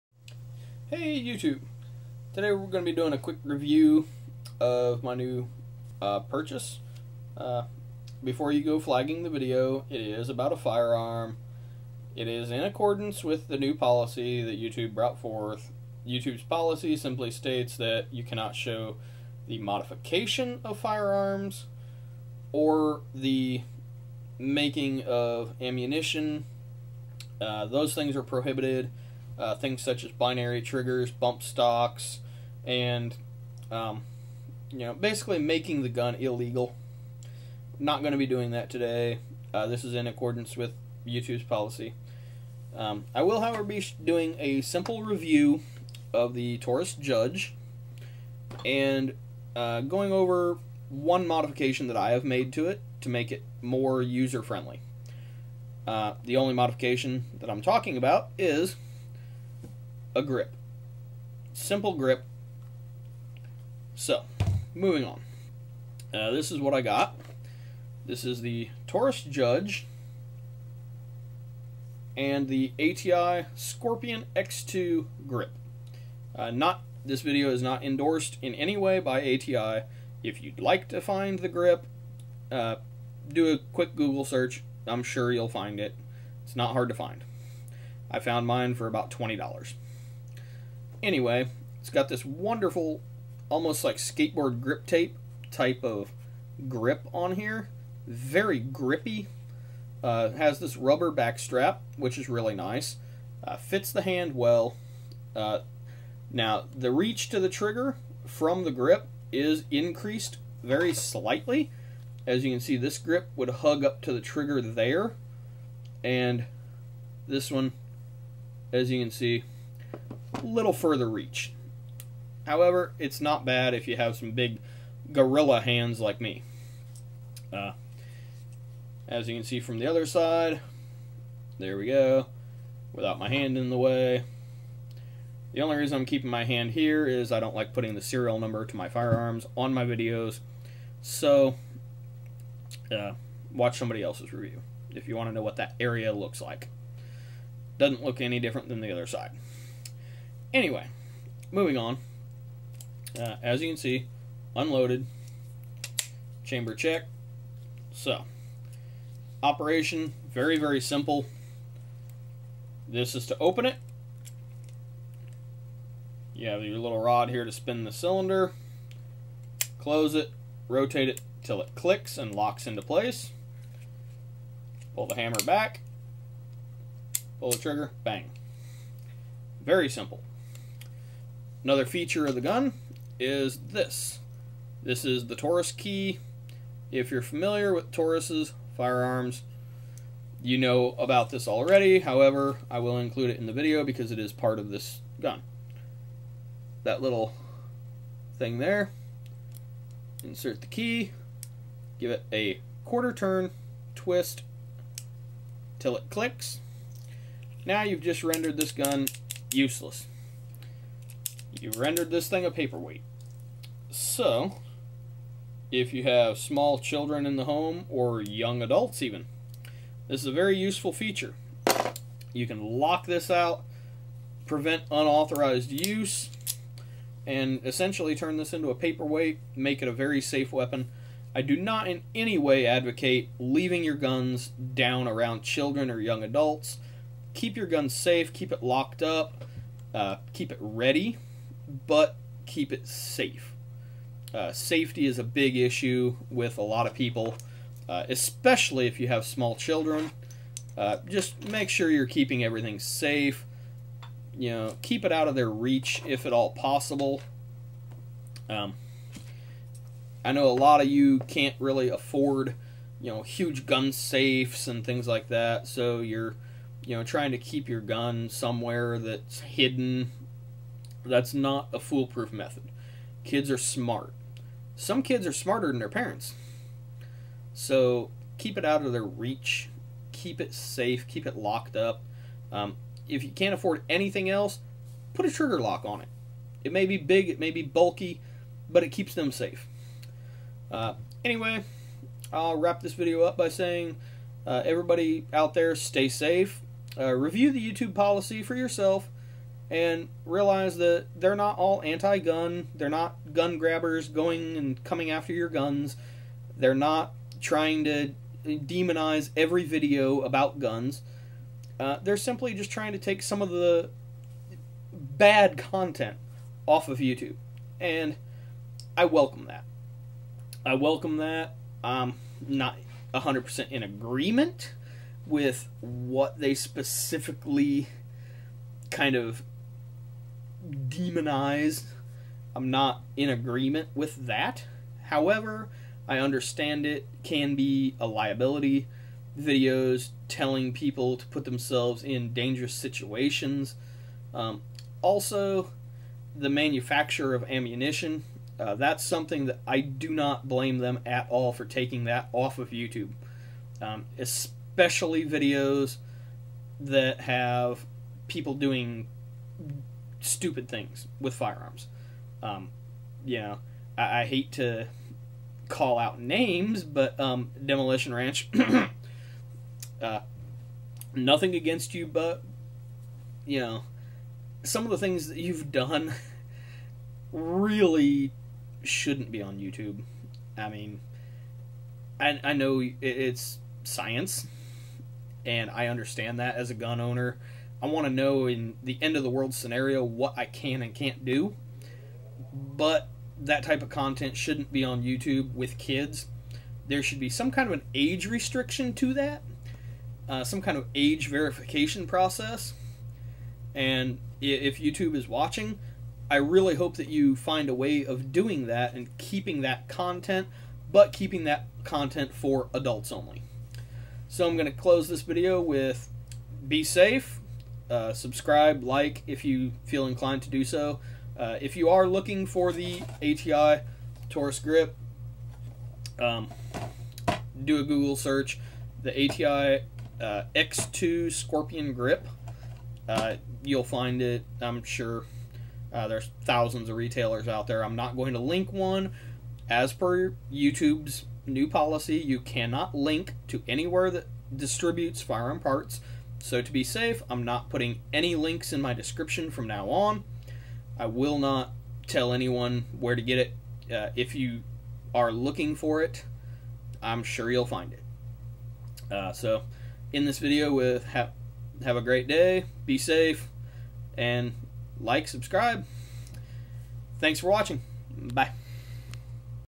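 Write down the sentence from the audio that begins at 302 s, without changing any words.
They're not gun grabbers going and coming after your guns.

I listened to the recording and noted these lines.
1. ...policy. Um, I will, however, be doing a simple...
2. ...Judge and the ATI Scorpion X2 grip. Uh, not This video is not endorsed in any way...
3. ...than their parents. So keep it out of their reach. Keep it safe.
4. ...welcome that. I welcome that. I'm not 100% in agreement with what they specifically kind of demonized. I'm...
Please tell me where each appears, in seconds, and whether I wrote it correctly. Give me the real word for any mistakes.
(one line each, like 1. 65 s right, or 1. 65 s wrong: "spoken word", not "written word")
1. 41 s right
2. 69 s right
3. 275 s right
4. 319 s right.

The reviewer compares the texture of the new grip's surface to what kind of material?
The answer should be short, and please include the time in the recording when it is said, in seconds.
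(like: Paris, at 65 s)
skateboard grip tape, at 93 s.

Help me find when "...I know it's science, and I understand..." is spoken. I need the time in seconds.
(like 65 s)
382 s.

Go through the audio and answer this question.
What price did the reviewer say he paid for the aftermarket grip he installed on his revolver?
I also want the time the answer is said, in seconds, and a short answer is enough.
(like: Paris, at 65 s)
$20, at 89 s.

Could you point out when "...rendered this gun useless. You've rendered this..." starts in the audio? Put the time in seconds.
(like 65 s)
208 s.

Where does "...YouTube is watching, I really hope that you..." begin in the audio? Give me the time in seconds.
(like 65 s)
404 s.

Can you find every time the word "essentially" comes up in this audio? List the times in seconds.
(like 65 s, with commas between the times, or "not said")
227 s.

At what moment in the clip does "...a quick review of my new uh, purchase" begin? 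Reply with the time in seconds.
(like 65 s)
3 s.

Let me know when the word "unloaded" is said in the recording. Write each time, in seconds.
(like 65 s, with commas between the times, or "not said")
154 s.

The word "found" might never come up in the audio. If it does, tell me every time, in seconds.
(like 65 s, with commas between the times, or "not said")
88 s.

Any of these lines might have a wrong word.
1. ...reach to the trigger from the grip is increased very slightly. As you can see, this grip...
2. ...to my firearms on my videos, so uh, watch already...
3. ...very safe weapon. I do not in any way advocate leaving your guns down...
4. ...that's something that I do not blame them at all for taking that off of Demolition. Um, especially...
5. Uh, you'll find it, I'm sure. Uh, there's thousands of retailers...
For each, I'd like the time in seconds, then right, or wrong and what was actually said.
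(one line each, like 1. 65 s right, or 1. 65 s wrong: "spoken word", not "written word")
1. 106 s right
2. 138 s wrong: "somebody", not "already"
3. 229 s right
4. 348 s wrong: "YouTube", not "Demolition"
5. 433 s right.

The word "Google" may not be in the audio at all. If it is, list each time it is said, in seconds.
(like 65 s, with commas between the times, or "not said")
83 s, 427 s.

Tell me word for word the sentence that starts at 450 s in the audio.
I will not tell anyone where to get it.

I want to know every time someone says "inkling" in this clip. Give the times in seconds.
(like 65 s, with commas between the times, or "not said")
not said.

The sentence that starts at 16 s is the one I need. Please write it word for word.
YouTube's policy simply states that you cannot show the modification of firearms or the making of ammunition.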